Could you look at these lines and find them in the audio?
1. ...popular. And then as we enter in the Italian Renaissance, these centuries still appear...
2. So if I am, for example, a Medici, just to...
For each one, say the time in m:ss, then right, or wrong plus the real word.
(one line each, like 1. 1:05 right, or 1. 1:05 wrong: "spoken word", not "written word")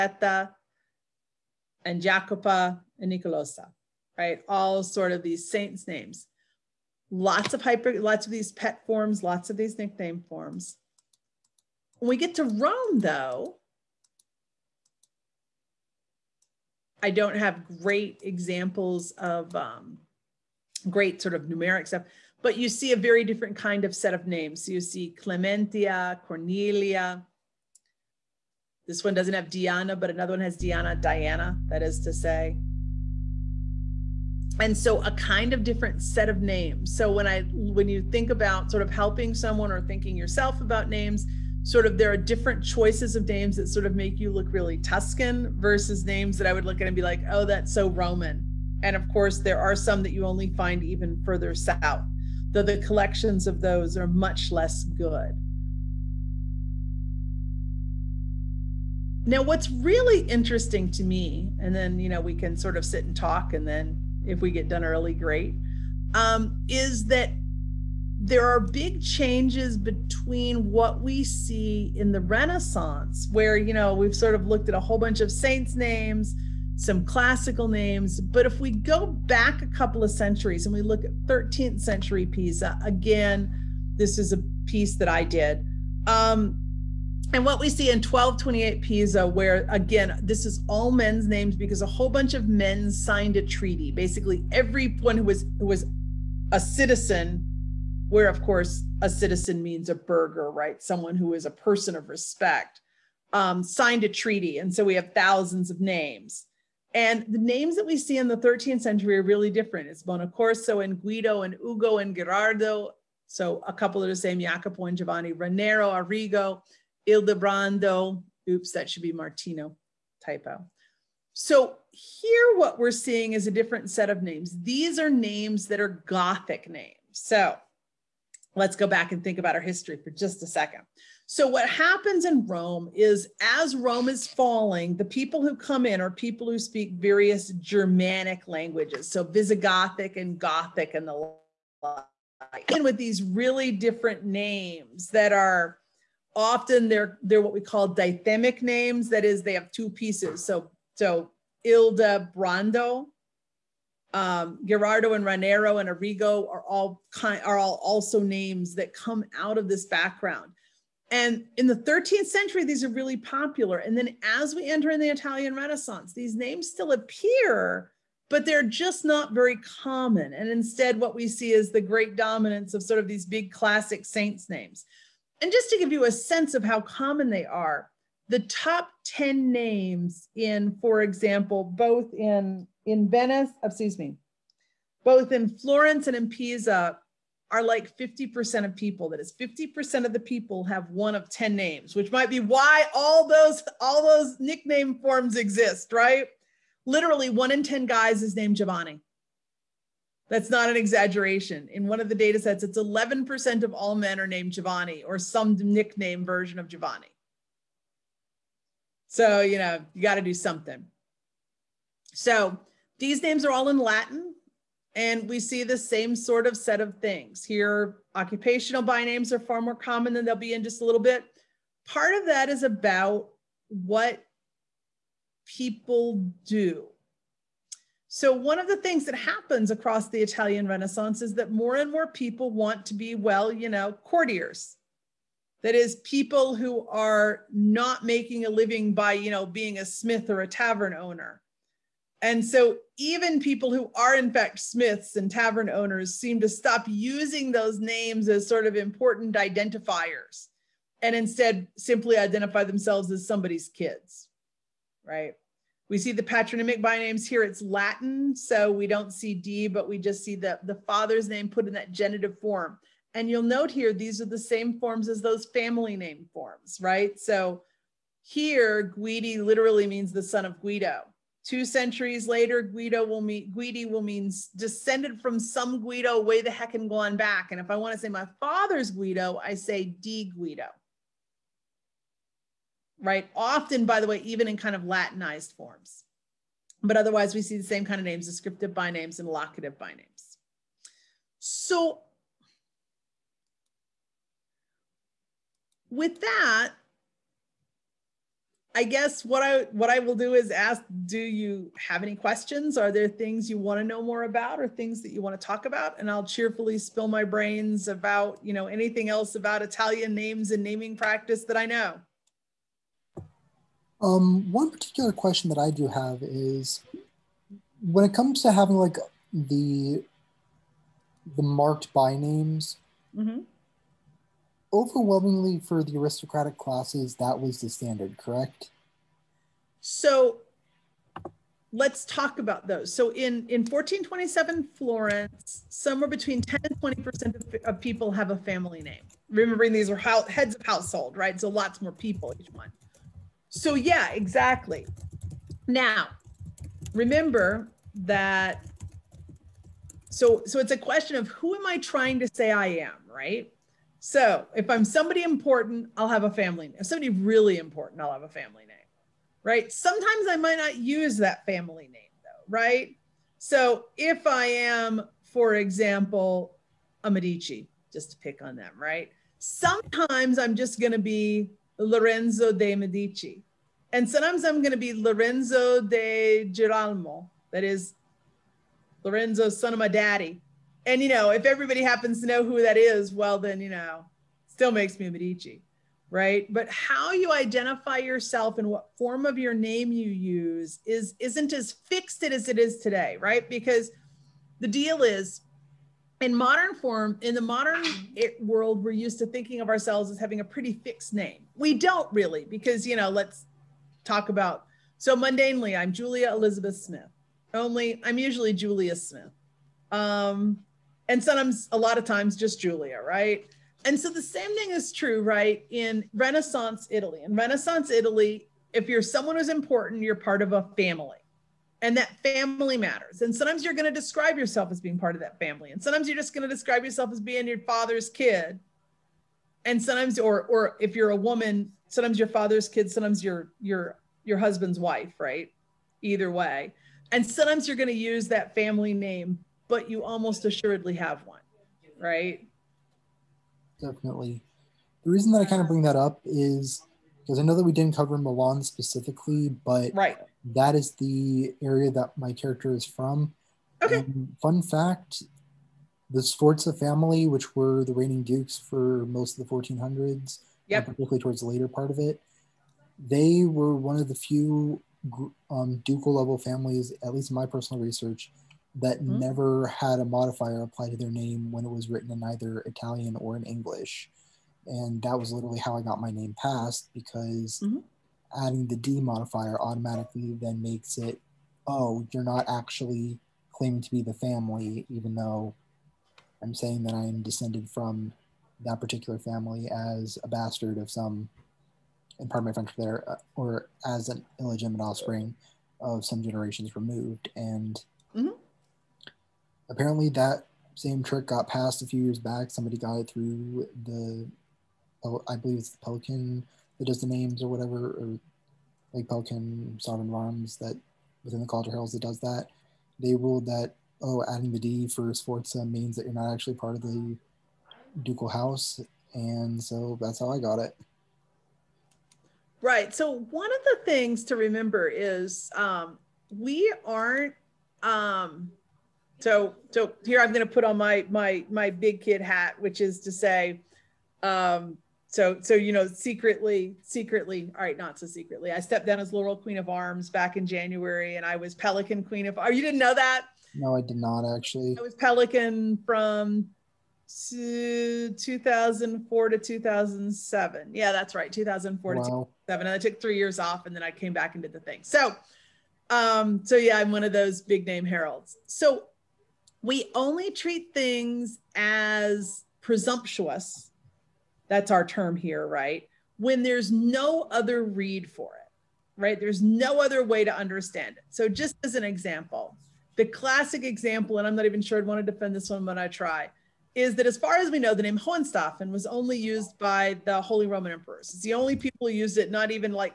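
1. 2:43 wrong: "names", not "centuries"
2. 6:03 right.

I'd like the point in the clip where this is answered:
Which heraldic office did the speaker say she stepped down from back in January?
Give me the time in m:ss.
8:59.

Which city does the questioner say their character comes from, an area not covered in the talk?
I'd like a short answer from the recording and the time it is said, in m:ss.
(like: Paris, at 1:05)
Milan, at 7:28.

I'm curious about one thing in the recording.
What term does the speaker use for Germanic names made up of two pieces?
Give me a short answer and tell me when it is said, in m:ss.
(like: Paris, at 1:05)
dithemic, at 2:27.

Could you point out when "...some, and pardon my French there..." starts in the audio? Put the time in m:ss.
8:10.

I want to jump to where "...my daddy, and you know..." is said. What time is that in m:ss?
6:19.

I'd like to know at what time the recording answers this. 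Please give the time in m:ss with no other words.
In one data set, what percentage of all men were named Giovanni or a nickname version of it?
3:22.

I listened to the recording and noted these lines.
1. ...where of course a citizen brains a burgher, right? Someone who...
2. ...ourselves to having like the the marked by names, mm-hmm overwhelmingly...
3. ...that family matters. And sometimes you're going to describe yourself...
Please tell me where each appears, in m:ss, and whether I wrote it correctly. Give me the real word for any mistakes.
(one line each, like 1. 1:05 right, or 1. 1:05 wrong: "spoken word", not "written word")
1. 1:38 wrong: "means", not "brains"
2. 5:18 wrong: "comes", not "ourselves"
3. 7:01 right.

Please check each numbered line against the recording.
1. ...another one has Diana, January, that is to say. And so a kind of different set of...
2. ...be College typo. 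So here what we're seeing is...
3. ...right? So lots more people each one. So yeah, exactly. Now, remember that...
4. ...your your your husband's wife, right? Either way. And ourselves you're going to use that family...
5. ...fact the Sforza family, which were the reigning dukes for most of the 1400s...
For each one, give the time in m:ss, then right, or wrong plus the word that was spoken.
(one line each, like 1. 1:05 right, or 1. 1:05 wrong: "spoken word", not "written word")
1. 0:30 wrong: "Diana", not "January"
2. 1:59 wrong: "Martino", not "College"
3. 5:41 right
4. 7:13 wrong: "sometimes", not "ourselves"
5. 7:34 right.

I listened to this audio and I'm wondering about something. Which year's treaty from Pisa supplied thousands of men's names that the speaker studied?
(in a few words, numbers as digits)
1228.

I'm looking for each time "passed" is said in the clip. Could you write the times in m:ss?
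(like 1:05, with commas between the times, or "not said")
7:56, 8:21.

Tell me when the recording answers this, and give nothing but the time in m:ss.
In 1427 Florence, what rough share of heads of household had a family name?
5:36.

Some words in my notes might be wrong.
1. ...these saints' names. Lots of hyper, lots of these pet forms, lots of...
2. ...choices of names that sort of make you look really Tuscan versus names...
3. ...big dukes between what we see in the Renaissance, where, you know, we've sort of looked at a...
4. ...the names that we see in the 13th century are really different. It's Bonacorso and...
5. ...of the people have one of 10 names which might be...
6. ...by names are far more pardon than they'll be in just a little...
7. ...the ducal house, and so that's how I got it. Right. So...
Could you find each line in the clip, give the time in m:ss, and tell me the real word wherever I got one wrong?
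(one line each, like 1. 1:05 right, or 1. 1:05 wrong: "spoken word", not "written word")
1. 0:05 right
2. 0:42 right
3. 1:08 wrong: "changes", not "dukes"
4. 1:47 right
5. 3:10 right
6. 3:38 wrong: "common", not "pardon"
7. 8:36 right.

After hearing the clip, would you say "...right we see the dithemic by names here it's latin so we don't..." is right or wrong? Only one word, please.
wrong.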